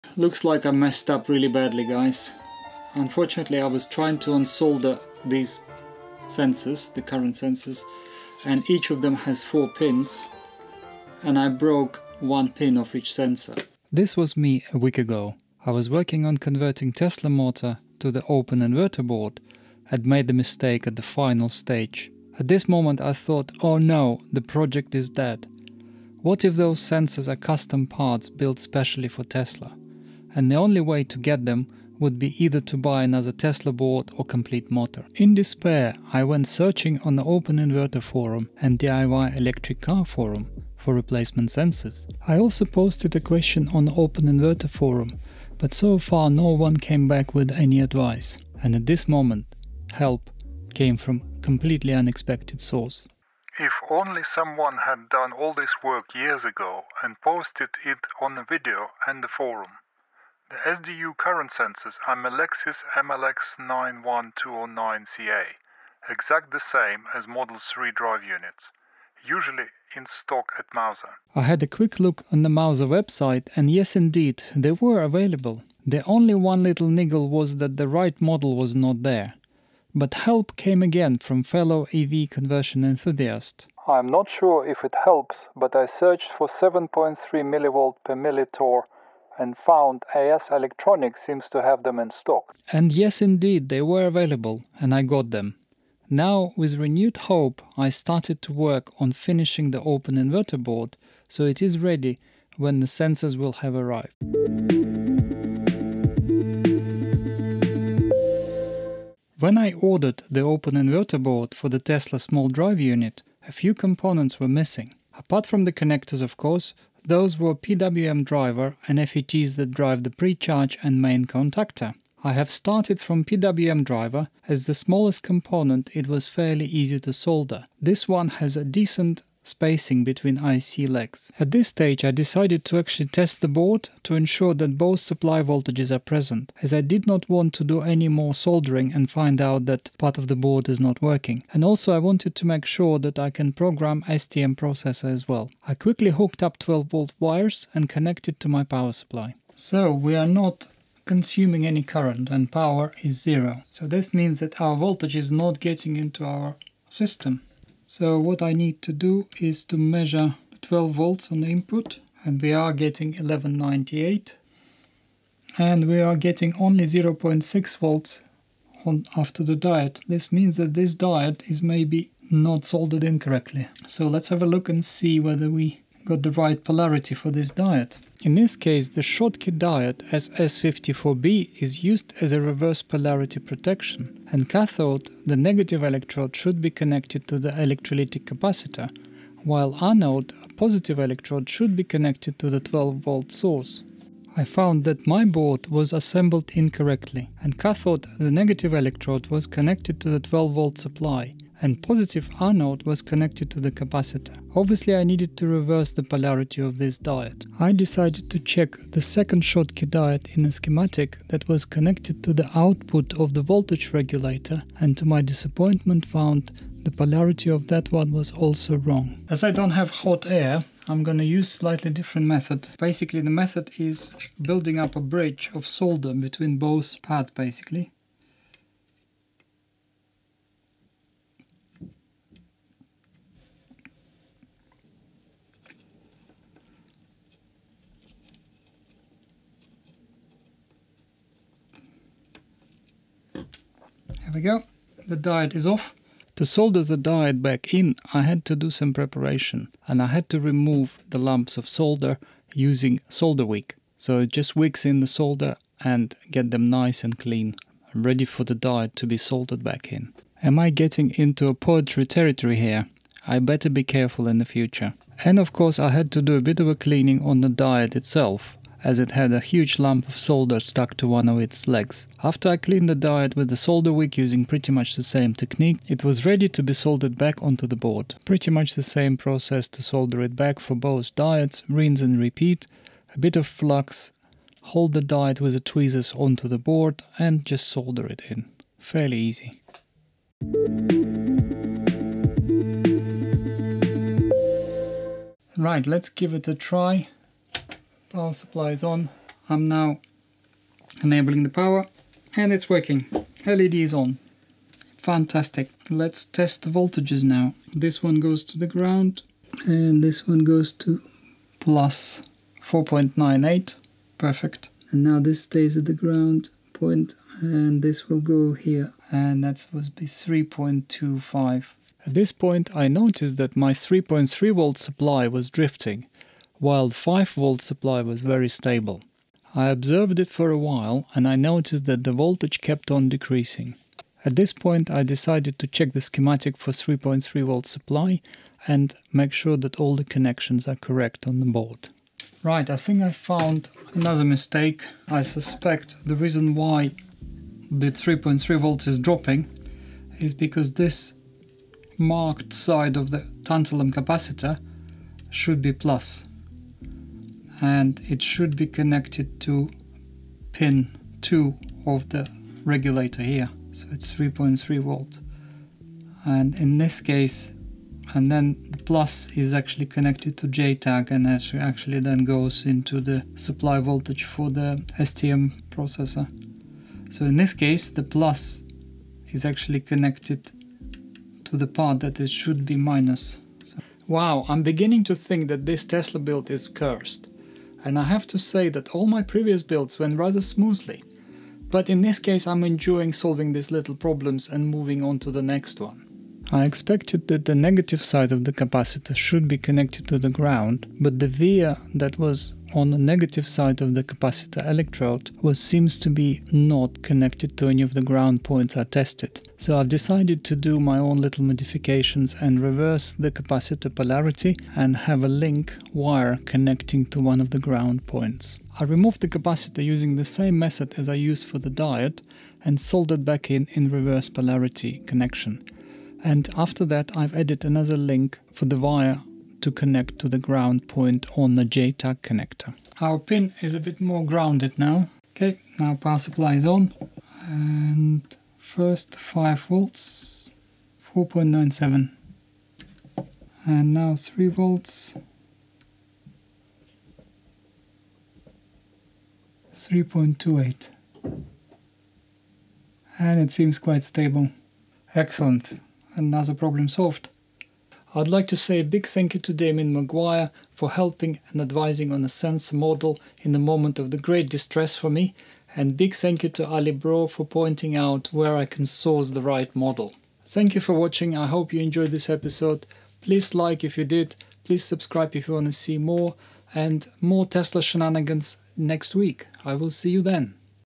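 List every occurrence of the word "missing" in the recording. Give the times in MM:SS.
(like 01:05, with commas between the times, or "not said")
01:54.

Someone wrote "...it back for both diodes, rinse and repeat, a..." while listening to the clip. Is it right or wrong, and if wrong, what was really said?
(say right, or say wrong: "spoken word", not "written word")
right.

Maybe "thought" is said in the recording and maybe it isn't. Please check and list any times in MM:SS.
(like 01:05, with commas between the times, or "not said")
00:23.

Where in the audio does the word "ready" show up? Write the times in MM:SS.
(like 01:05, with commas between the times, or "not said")
01:41, 04:17, 04:36.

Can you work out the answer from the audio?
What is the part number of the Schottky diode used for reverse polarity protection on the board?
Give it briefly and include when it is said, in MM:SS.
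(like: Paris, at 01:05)
SS54B, at 03:00.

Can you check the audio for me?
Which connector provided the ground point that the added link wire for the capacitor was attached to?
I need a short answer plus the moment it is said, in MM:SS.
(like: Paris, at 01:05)
JTAG connector, at 07:11.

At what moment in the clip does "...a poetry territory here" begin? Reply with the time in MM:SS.
04:21.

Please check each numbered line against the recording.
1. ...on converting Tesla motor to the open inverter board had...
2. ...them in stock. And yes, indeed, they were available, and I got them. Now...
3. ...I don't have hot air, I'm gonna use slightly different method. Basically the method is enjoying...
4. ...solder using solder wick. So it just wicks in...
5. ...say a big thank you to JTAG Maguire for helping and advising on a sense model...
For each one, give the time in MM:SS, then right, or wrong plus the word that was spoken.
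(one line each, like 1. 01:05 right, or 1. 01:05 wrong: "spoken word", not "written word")
1. 00:16 right
2. 01:31 right
3. 03:39 wrong: "building", not "enjoying"
4. 04:11 right
5. 07:38 wrong: "Damien", not "JTAG".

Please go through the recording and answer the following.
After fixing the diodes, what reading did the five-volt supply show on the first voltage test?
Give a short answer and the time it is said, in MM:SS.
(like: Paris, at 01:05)
4.98, at 05:11.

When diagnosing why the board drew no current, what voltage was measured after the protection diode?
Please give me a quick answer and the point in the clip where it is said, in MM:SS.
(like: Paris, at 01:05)
0.6 volts, at 02:46.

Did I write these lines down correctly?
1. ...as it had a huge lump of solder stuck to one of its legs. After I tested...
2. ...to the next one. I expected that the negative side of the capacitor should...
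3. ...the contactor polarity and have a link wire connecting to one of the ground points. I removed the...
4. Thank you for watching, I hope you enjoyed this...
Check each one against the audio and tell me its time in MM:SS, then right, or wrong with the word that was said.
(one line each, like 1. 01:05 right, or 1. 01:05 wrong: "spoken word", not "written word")
1. 04:28 wrong: "cleaned", not "tested"
2. 06:35 right
3. 06:53 wrong: "capacitor", not "contactor"
4. 07:50 right.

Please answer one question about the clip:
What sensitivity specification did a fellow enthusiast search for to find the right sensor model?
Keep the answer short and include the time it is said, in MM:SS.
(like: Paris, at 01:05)
7.3 millivolt per millitesla, at 01:26.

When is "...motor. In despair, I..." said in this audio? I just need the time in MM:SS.
00:34.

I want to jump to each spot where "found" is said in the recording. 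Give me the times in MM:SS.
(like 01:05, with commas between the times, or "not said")
01:29, 03:14, 03:36, 05:43.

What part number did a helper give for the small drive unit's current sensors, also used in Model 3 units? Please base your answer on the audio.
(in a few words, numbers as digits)
Melexis MLX91209CA.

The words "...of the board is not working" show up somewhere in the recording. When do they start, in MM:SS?
02:20.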